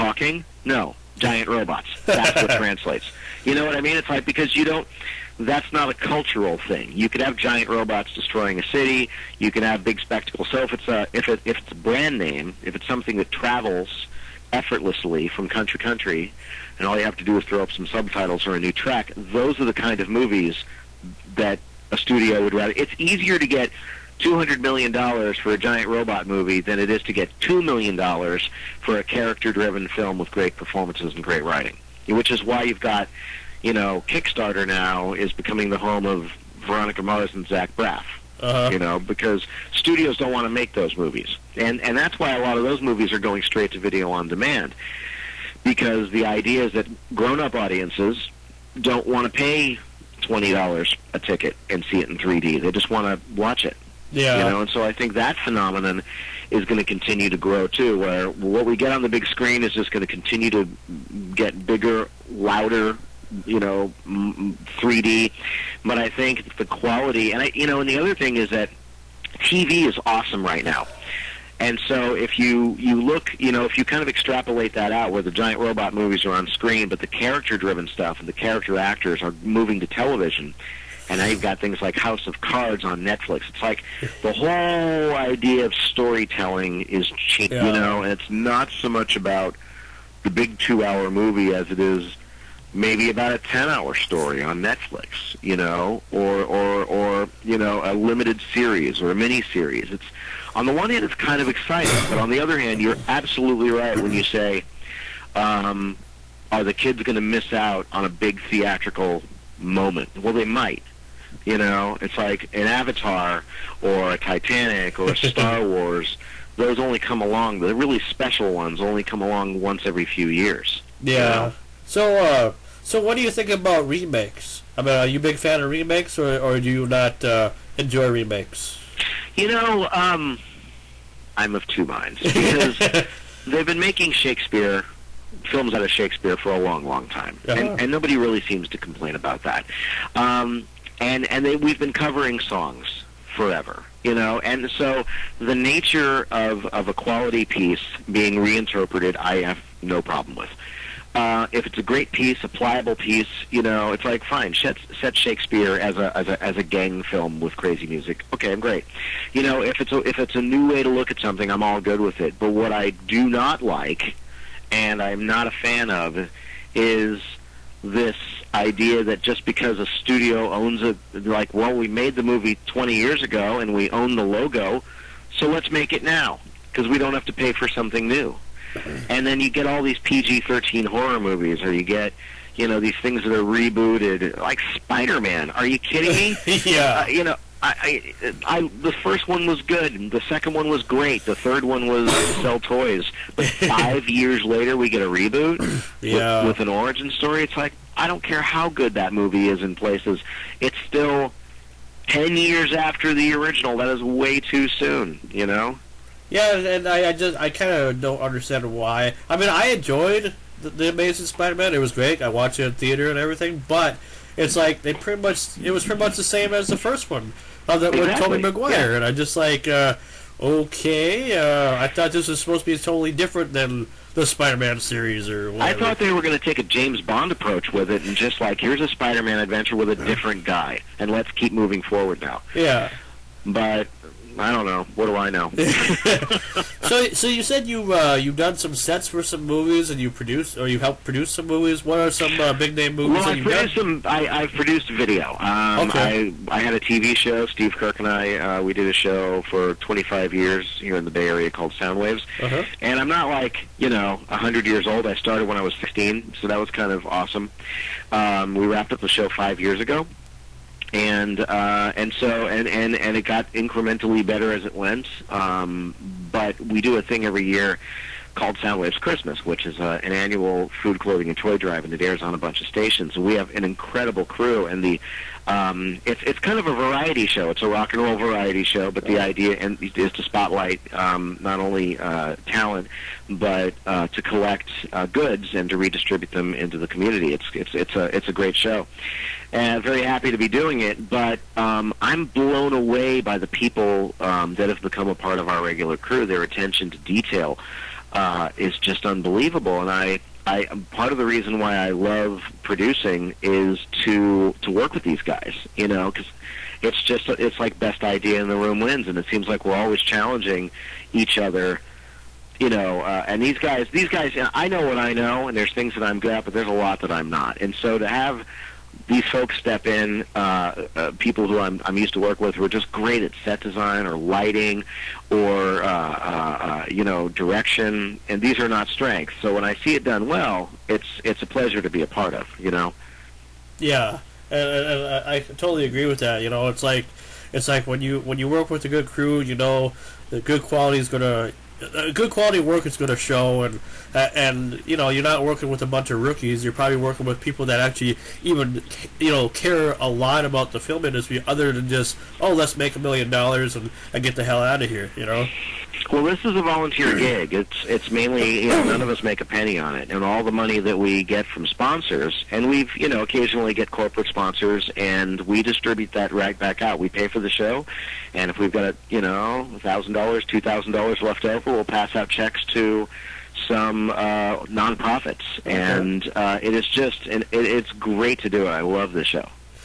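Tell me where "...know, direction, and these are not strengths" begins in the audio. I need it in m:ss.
5:27.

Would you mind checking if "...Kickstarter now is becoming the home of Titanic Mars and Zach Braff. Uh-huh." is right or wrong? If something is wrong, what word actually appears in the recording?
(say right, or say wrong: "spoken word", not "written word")
wrong: "Veronica", not "Titanic".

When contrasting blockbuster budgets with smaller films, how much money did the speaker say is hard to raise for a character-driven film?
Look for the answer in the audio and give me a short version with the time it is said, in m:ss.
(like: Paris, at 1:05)
$2 million, at 0:27.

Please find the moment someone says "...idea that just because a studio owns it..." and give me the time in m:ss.
2:48.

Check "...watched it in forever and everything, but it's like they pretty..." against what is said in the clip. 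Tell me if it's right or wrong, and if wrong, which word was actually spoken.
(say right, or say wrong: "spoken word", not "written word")
wrong: "theater", not "forever".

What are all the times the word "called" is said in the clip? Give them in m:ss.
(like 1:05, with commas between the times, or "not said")
4:11, 4:28.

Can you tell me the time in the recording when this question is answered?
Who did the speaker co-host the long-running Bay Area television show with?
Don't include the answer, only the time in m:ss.
4:07.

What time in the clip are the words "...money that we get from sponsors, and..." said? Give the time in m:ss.
6:00.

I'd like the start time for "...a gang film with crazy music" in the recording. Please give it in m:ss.
2:36.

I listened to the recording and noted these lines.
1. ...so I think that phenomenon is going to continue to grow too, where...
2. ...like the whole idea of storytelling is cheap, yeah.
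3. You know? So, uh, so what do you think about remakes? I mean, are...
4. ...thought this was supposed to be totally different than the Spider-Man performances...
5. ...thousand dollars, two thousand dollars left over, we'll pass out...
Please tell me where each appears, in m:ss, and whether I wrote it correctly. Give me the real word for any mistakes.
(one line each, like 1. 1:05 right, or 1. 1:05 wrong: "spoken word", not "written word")
1. 0:54 right
2. 1:23 right
3. 2:01 right
4. 3:41 wrong: "series", not "performances"
5. 6:09 right.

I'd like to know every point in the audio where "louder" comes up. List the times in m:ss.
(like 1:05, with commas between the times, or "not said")
1:02.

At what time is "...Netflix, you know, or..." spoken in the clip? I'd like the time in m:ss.
1:34.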